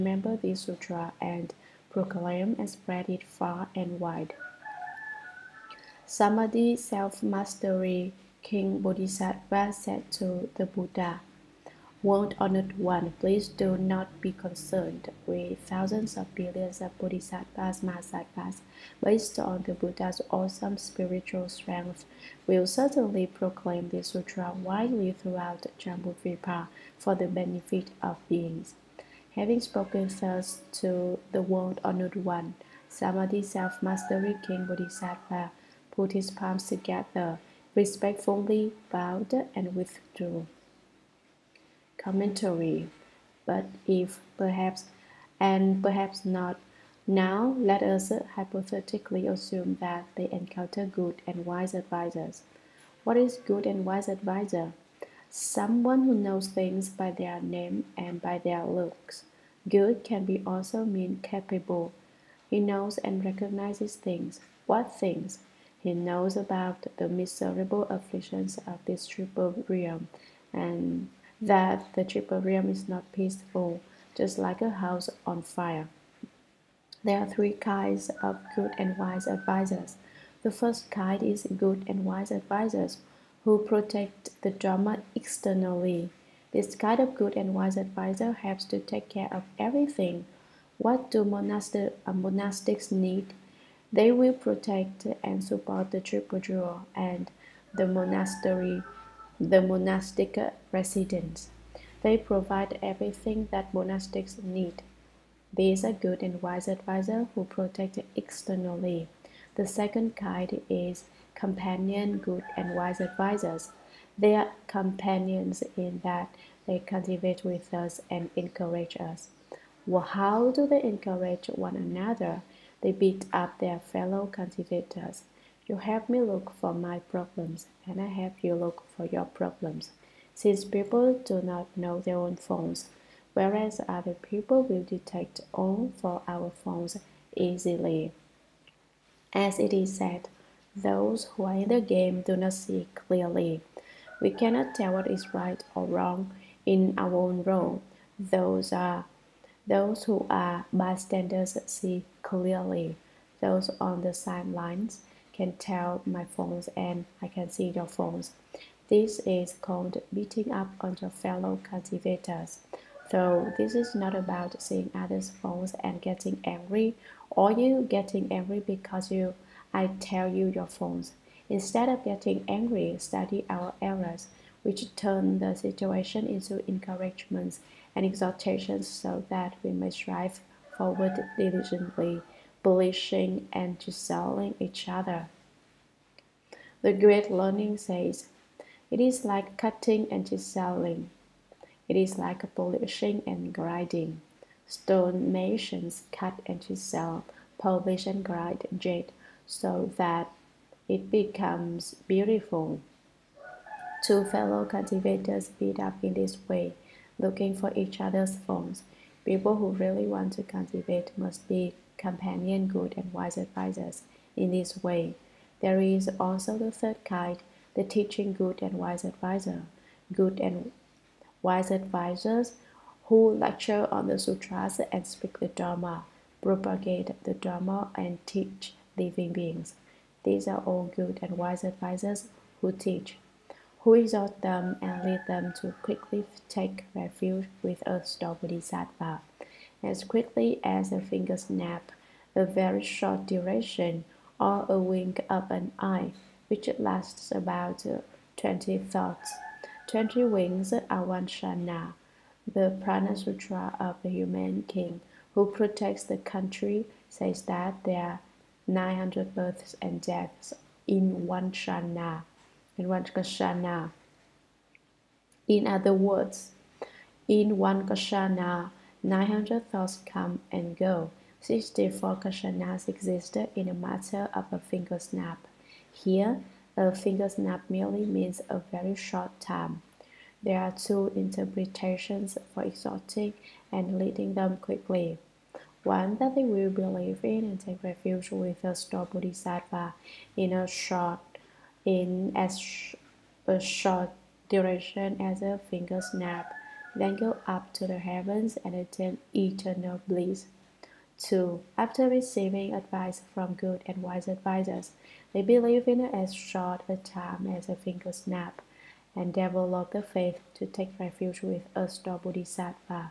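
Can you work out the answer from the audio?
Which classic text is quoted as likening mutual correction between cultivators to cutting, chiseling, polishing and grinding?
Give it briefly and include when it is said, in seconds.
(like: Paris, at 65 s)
The Great Learning, at 186 s.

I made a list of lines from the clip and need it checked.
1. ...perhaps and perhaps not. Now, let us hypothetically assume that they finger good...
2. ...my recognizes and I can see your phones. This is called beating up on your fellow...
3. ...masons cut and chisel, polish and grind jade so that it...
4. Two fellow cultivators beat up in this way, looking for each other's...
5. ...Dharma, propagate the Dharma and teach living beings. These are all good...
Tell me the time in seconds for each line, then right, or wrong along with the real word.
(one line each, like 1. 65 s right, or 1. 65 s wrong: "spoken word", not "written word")
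1. 44 s wrong: "encounter", not "finger"
2. 156 s wrong: "phones", not "recognizes"
3. 195 s right
4. 204 s right
5. 225 s right.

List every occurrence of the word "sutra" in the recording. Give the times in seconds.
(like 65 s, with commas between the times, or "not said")
0 s, 24 s, 224 s, 253 s.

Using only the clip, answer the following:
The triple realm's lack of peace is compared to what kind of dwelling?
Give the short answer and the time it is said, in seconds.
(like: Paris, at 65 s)
A house on fire, at 74 s.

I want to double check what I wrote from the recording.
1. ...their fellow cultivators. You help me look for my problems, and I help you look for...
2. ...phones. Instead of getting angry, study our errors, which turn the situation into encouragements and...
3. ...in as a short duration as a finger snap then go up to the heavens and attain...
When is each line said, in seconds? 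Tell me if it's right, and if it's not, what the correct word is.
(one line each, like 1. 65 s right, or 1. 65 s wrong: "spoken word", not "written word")
1. 123 s right
2. 170 s right
3. 291 s right.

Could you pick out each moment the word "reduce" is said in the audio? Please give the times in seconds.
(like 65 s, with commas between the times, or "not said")
not said.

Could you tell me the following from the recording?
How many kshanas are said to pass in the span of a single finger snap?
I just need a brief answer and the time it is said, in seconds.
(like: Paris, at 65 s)
64, at 271 s.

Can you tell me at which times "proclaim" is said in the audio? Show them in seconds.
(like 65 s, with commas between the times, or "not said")
1 s, 23 s.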